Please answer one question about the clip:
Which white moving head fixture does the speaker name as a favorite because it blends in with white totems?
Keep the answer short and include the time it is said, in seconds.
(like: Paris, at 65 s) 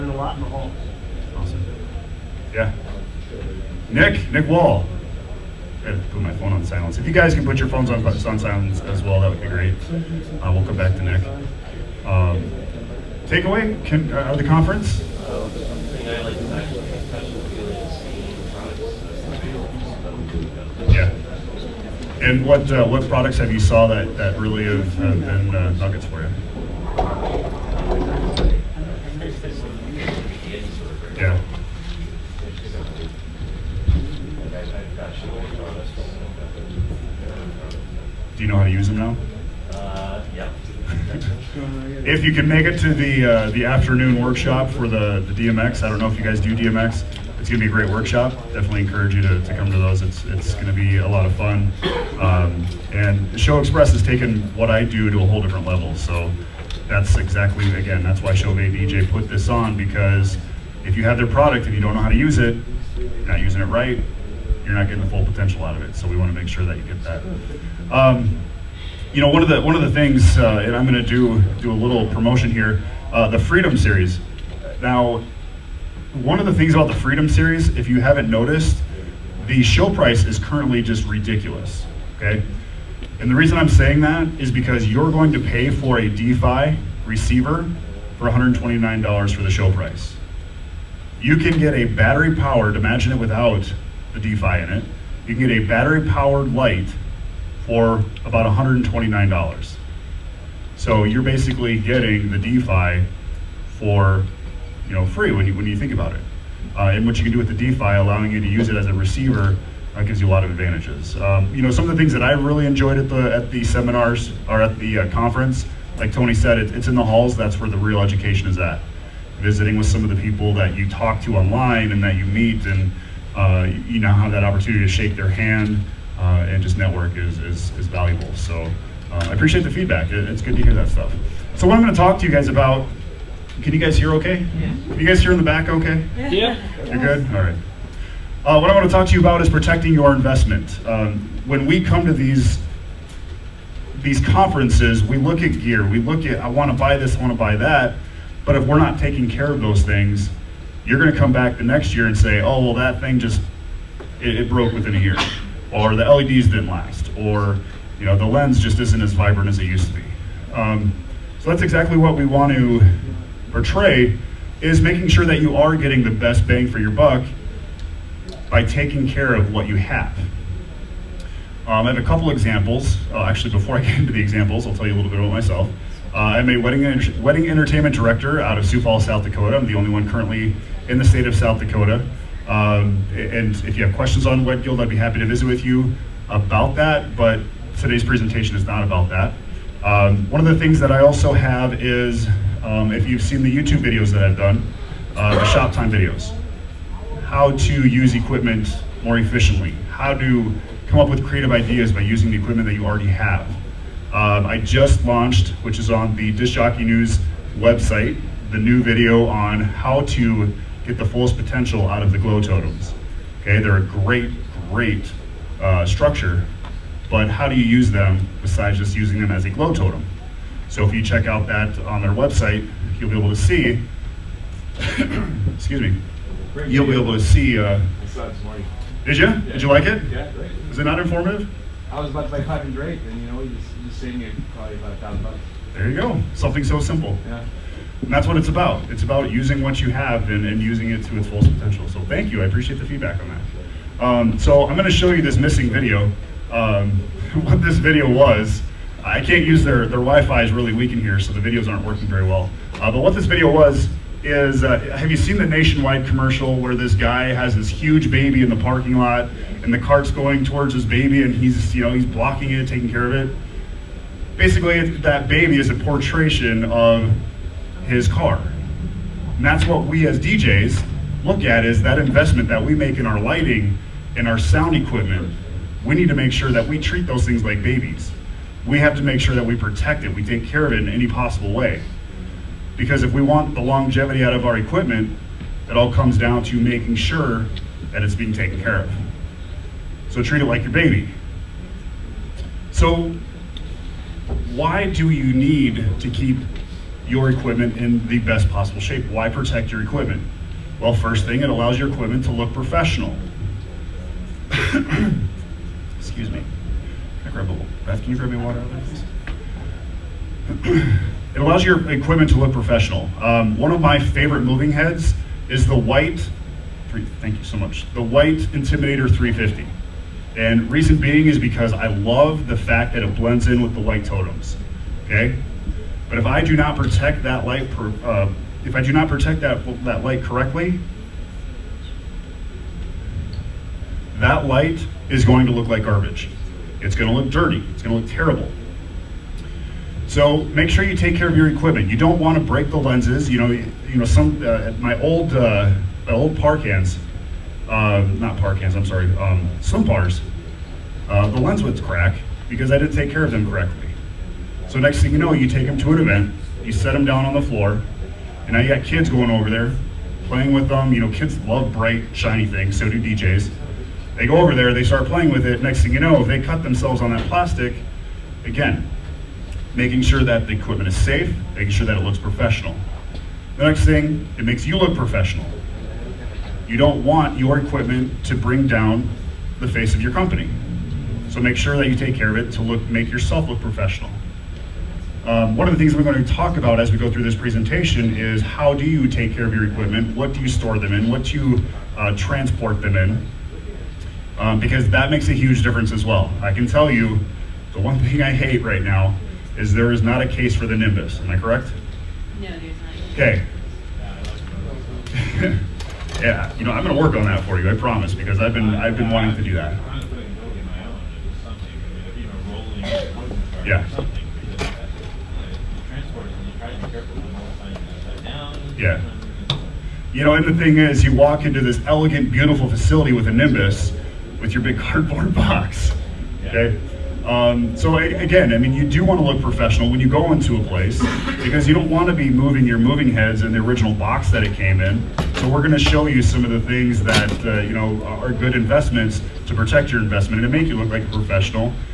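Intimidator 350, at 318 s.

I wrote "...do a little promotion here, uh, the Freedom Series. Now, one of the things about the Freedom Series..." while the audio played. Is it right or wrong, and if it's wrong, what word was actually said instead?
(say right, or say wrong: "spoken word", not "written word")
right.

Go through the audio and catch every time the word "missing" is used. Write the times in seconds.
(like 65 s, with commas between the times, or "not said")
245 s.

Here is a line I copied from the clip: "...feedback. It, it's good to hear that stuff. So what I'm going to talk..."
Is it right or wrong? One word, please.
right.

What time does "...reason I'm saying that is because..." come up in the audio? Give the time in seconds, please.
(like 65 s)
83 s.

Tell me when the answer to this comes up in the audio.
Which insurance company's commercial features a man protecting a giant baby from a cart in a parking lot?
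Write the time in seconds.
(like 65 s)
255 s.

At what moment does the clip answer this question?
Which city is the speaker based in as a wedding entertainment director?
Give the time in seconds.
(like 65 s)
178 s.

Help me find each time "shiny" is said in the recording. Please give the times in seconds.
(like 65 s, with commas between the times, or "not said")
362 s.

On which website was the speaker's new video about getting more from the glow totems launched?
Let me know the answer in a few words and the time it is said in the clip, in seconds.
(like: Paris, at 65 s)
Disc Jockey News, at 206 s.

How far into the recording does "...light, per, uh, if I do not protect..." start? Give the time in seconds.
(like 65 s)
327 s.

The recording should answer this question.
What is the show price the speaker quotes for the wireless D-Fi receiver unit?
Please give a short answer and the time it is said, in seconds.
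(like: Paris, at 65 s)
$129, at 88 s.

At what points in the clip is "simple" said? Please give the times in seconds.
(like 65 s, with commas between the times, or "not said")
236 s.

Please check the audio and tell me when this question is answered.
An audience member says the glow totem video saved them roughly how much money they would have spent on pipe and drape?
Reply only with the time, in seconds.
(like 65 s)
234 s.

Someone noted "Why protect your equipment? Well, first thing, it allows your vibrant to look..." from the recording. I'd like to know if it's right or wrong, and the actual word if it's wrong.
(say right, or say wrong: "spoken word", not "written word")
wrong: "equipment", not "vibrant".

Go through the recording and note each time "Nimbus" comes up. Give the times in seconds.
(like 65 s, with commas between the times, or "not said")
400 s, 423 s.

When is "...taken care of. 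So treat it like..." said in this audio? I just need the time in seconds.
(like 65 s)
288 s.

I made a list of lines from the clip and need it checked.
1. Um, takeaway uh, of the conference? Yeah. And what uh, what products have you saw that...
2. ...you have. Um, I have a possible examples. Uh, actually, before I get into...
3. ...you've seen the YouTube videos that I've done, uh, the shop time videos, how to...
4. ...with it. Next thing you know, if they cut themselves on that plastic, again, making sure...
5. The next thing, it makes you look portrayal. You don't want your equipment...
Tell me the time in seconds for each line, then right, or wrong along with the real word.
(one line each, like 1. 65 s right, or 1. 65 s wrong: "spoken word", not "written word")
1. 12 s right
2. 169 s wrong: "couple", not "possible"
3. 193 s right
4. 365 s right
5. 373 s wrong: "professional", not "portrayal".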